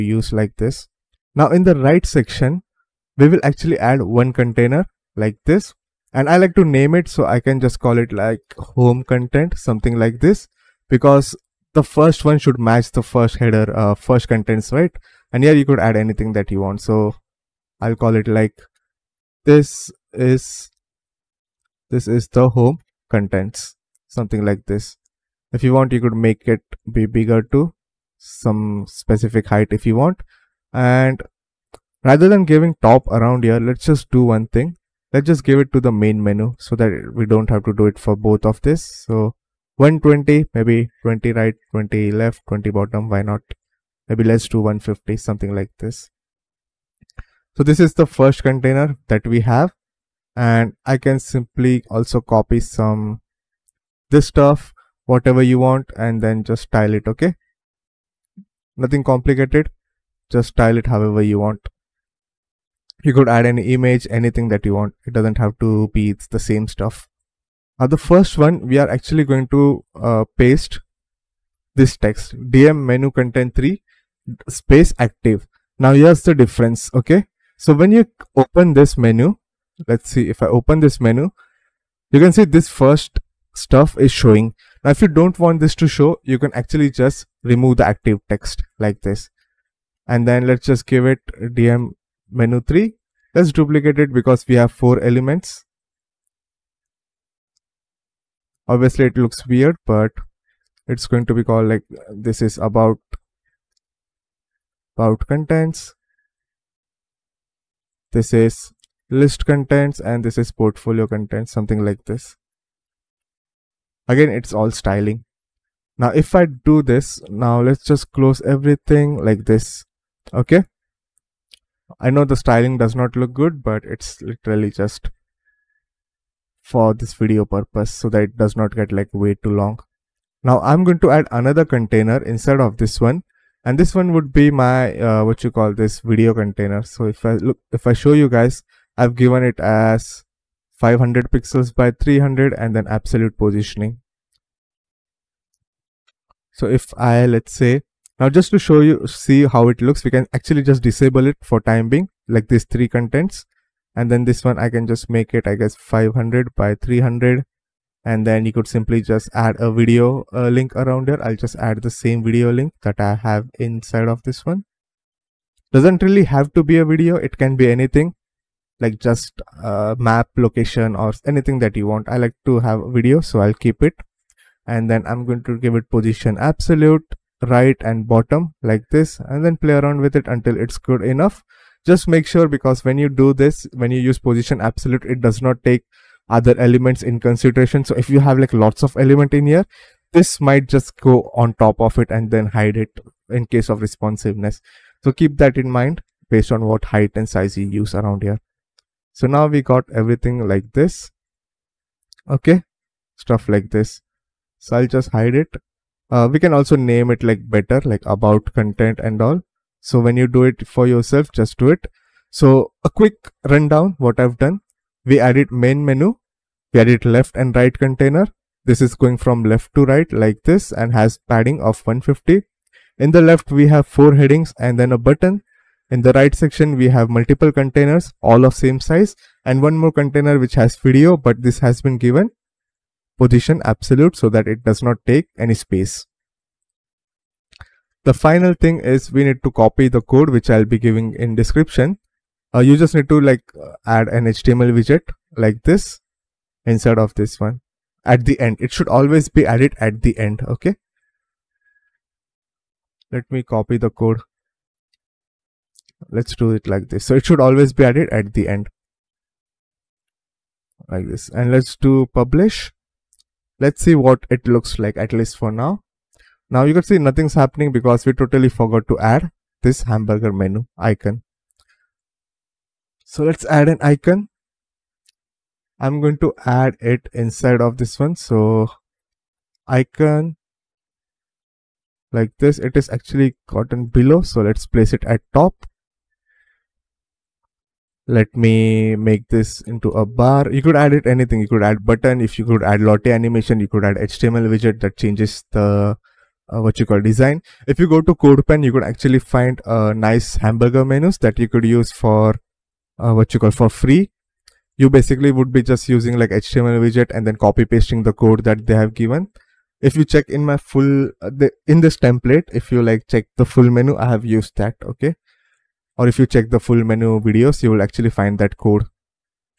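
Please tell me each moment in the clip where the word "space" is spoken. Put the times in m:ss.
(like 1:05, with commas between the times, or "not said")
1:14, 3:55.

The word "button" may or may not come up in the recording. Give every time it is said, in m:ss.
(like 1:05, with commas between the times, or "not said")
3:44, 4:51.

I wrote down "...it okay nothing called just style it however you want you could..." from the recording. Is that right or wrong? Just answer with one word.
wrong.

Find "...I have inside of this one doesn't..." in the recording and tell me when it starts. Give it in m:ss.
2:43.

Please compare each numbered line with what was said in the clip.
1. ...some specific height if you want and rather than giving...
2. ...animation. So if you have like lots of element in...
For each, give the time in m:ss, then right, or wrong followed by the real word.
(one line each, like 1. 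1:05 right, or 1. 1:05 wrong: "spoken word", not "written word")
1. 0:28 right
2. 3:07 wrong: "consideration", not "animation".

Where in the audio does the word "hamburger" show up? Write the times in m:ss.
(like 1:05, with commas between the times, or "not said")
4:29, 5:00.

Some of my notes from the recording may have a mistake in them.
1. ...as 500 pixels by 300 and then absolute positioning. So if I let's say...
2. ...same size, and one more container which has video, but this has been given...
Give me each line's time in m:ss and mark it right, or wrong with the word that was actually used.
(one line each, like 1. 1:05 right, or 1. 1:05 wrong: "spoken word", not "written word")
1. 2:19 right
2. 3:48 right.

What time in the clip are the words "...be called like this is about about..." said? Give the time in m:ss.
1:41.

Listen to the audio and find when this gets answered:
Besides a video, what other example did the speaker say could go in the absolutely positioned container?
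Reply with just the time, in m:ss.
2:49.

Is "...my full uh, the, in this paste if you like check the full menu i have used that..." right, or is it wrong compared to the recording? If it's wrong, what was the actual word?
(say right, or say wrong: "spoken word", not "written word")
wrong: "template", not "paste".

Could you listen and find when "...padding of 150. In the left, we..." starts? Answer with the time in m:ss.
3:41.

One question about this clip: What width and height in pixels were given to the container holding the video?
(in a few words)
500 by 300.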